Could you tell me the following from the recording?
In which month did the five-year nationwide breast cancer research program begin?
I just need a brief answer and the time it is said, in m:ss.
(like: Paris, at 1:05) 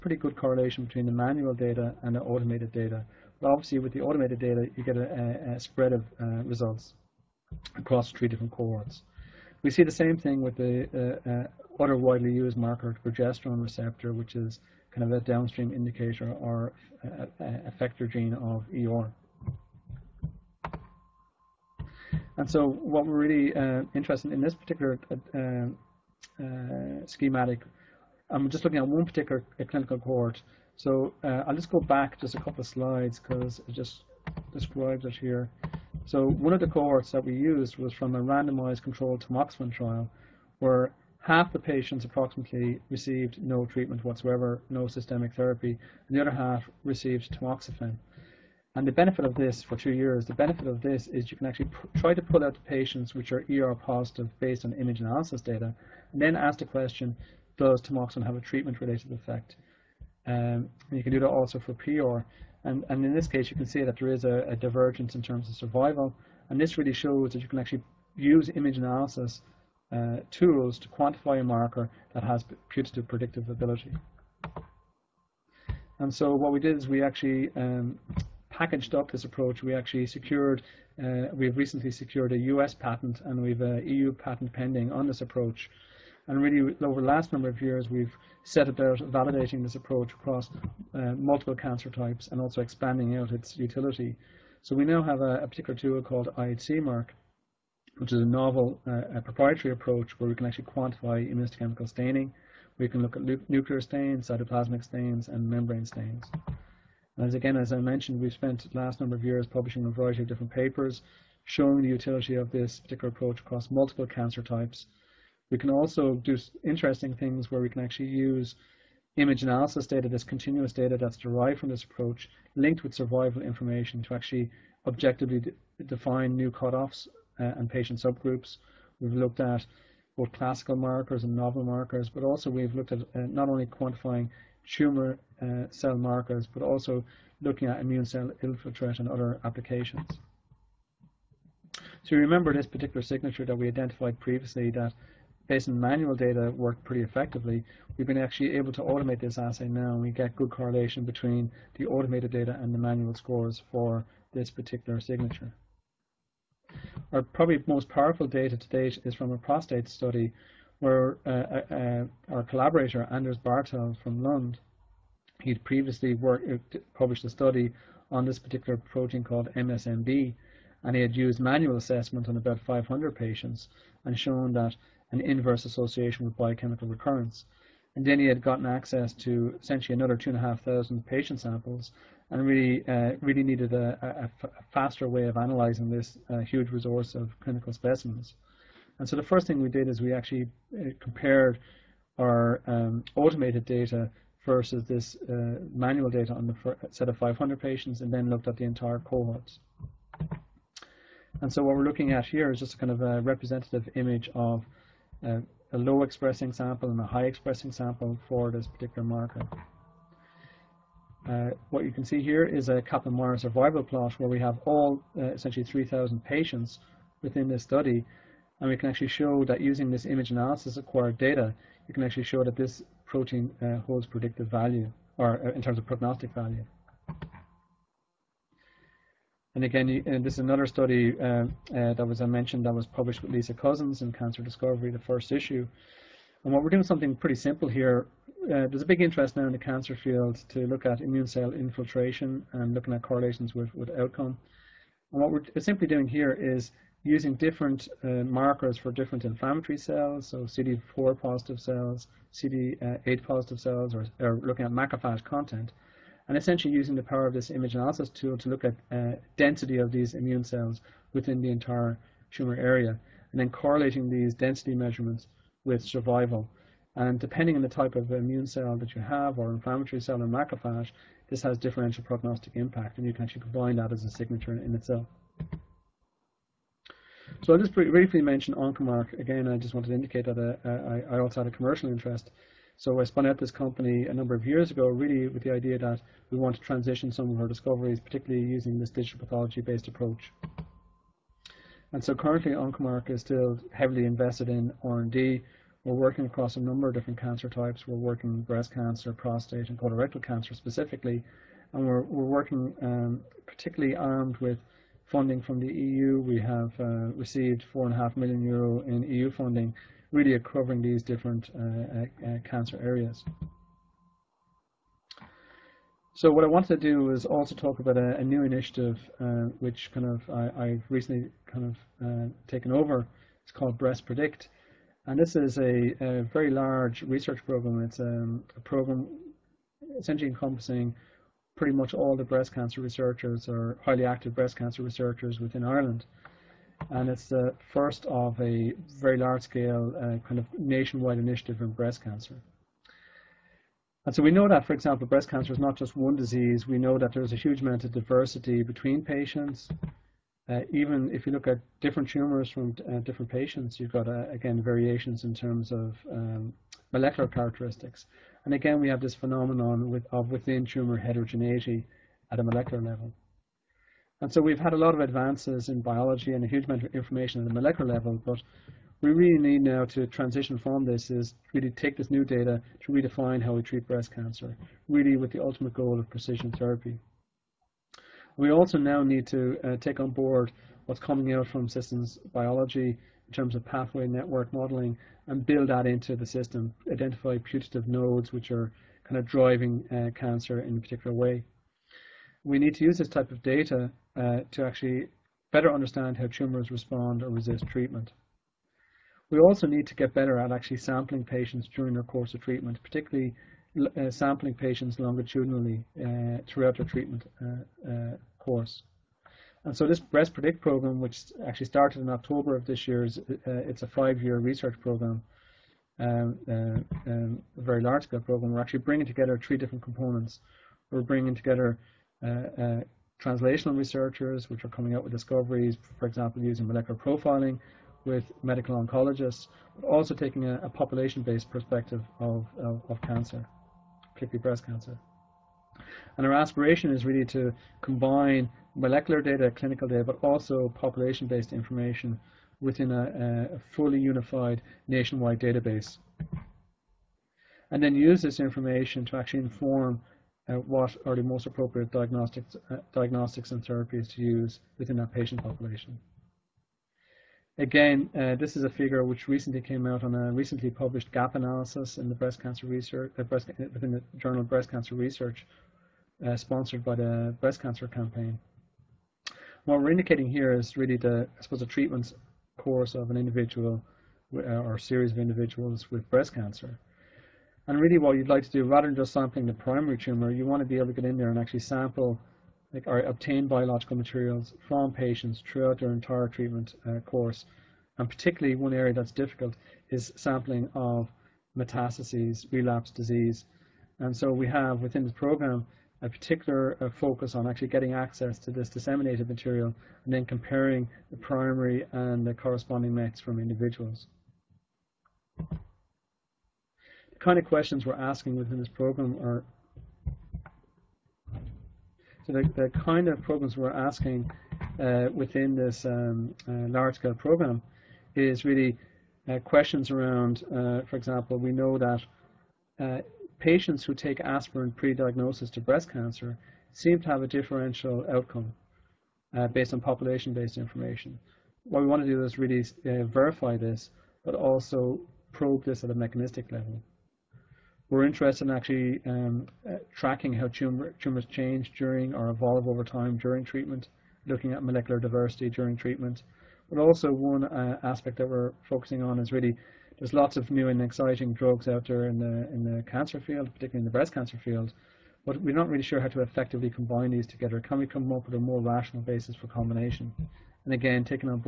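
October, at 6:52.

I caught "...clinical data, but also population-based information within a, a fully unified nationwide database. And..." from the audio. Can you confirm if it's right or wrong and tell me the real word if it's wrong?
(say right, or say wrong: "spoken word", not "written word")
right.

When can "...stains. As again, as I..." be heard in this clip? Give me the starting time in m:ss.
1:45.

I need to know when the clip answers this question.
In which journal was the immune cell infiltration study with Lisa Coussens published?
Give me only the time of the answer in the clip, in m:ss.
3:54.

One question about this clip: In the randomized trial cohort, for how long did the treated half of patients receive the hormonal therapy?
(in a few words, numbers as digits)
2 years.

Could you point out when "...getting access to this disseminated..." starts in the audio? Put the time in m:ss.
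8:17.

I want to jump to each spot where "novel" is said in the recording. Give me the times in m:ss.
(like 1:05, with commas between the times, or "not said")
1:38, 2:11.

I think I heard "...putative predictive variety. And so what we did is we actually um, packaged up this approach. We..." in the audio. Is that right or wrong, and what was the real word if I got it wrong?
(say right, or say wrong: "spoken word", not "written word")
wrong: "ability", not "variety".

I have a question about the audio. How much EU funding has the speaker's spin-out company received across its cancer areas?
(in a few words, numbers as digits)
4.5 million euro.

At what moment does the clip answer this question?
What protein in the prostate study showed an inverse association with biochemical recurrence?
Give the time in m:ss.
2:49.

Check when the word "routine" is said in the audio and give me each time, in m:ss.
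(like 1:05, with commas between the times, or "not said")
not said.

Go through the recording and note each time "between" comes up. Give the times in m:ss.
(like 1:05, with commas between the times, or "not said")
0:00, 2:31, 5:48.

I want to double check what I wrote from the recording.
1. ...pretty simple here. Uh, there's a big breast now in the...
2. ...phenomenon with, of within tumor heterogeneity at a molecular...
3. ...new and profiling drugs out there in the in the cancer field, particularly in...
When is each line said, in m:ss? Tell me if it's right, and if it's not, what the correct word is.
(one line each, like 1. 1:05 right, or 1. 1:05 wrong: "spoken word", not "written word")
1. 3:57 wrong: "interest", not "breast"
2. 5:59 right
3. 9:10 wrong: "exciting", not "profiling".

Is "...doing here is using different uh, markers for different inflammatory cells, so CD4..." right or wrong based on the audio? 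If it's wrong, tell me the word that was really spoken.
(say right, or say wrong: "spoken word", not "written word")
right.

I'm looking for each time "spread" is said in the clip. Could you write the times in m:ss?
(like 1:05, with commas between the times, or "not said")
0:05.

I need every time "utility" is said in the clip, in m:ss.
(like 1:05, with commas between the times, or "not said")
1:33, 1:51.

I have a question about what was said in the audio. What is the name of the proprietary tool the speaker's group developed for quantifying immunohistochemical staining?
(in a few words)
IHC Mark.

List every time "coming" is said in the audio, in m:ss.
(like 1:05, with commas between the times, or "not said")
6:21, 7:04.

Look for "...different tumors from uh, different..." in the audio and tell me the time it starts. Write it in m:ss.
5:51.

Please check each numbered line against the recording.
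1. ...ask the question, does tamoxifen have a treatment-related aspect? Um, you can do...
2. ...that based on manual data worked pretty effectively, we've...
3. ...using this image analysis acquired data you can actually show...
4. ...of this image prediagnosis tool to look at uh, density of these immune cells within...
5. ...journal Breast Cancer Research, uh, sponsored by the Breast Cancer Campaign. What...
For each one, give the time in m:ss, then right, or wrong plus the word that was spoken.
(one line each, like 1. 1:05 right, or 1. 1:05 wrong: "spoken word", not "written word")
1. 0:56 wrong: "effect", not "aspect"
2. 2:24 right
3. 3:39 right
4. 4:17 wrong: "analysis", not "prediagnosis"
5. 7:44 right.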